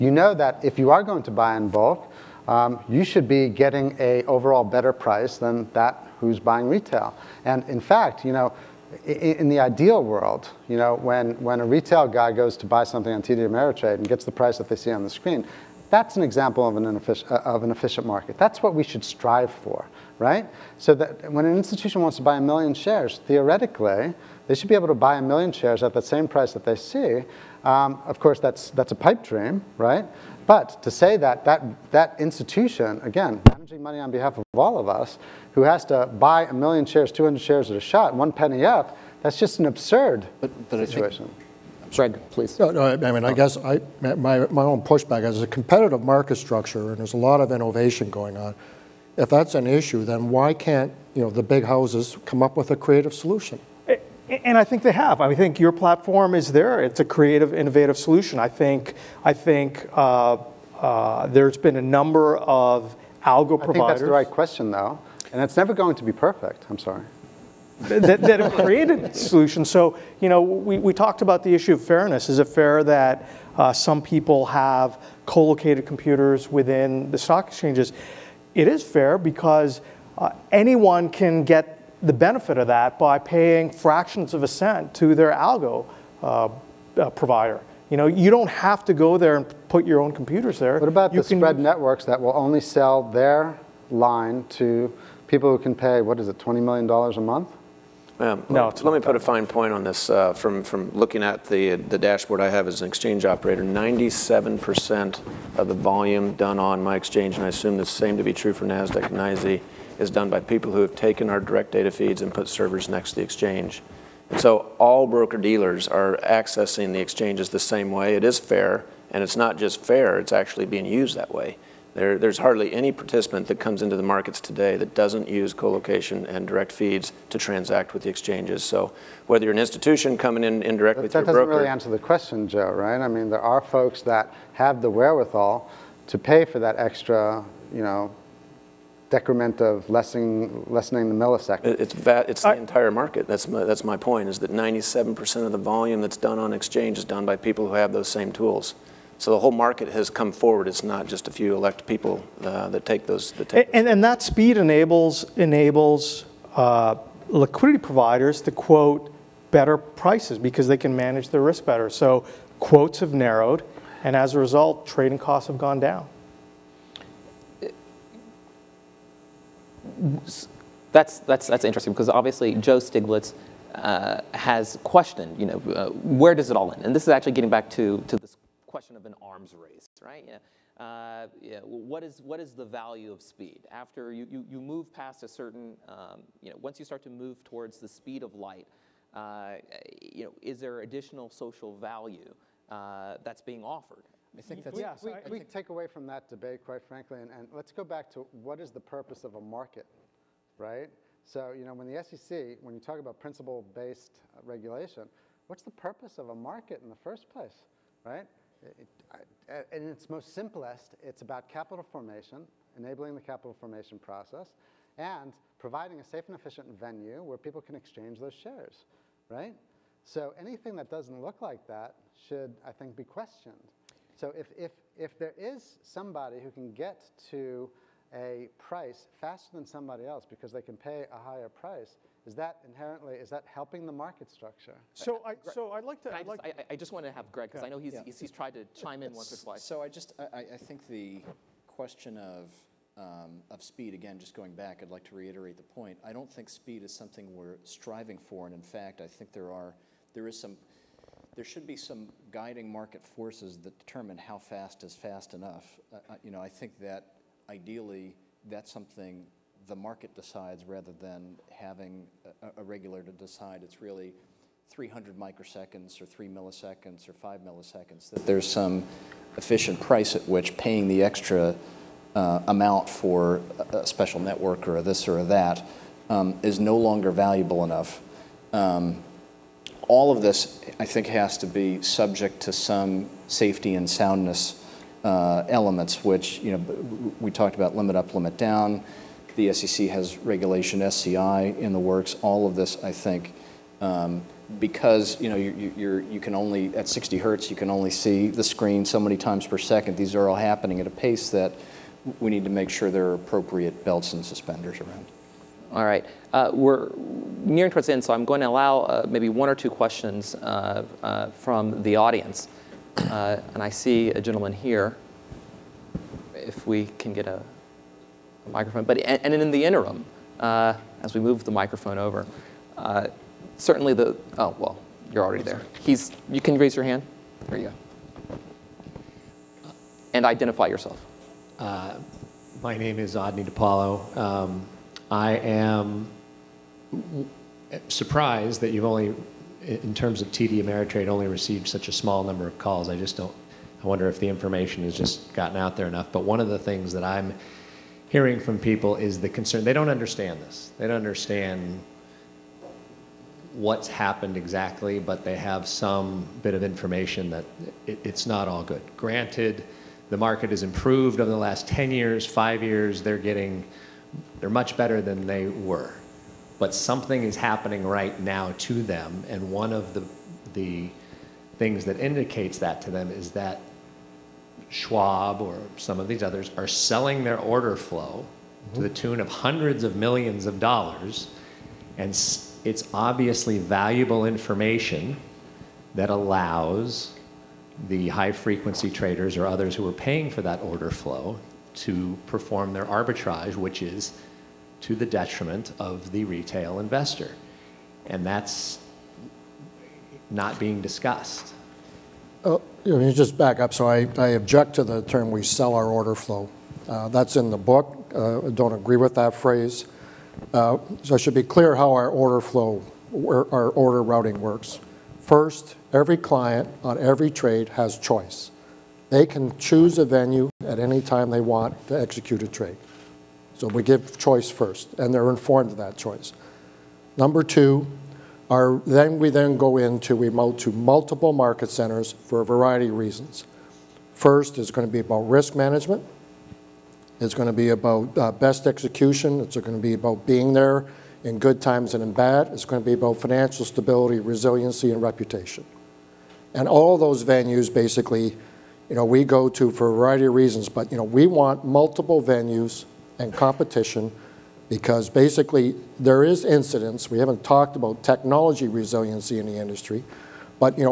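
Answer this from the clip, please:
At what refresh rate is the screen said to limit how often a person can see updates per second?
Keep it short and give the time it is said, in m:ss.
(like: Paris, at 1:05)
60 hertz, at 4:56.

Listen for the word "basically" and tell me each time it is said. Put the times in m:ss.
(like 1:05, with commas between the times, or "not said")
7:27, 7:35.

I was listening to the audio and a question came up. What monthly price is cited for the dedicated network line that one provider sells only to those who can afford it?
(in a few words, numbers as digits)
$20 million.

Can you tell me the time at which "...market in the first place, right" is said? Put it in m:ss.
3:26.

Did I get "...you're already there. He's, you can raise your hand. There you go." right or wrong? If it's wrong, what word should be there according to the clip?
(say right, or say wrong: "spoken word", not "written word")
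right.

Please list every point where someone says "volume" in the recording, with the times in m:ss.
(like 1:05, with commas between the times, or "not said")
1:45, 2:25.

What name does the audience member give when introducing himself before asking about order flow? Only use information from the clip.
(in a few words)
Odney DiPaolo.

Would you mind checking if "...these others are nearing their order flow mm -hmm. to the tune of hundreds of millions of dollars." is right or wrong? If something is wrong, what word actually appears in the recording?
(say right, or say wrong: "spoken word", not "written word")
wrong: "selling", not "nearing".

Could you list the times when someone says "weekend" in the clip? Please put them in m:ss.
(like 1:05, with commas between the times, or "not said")
not said.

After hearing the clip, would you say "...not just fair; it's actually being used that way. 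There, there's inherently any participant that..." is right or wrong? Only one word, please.
wrong.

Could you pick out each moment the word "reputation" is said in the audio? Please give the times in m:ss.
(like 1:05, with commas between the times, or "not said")
7:25.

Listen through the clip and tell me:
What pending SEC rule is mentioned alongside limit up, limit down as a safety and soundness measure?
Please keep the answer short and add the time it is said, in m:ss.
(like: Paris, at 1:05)
Regulation SCI, at 4:50.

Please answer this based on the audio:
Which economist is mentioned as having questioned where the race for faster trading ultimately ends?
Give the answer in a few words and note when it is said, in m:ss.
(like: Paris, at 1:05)
Joe Stiglitz, at 2:52.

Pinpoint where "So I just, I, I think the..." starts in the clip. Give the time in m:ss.
3:59.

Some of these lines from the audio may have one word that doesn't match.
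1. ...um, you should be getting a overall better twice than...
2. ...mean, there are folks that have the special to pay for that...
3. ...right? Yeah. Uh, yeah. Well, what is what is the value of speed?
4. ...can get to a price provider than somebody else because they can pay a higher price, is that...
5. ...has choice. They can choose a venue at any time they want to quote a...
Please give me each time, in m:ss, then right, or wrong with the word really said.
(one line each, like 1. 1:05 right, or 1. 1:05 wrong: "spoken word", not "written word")
1. 0:02 wrong: "price", not "twice"
2. 2:13 wrong: "wherewithal", not "special"
3. 3:00 right
4. 3:46 wrong: "faster", not "provider"
5. 6:57 wrong: "execute", not "quote".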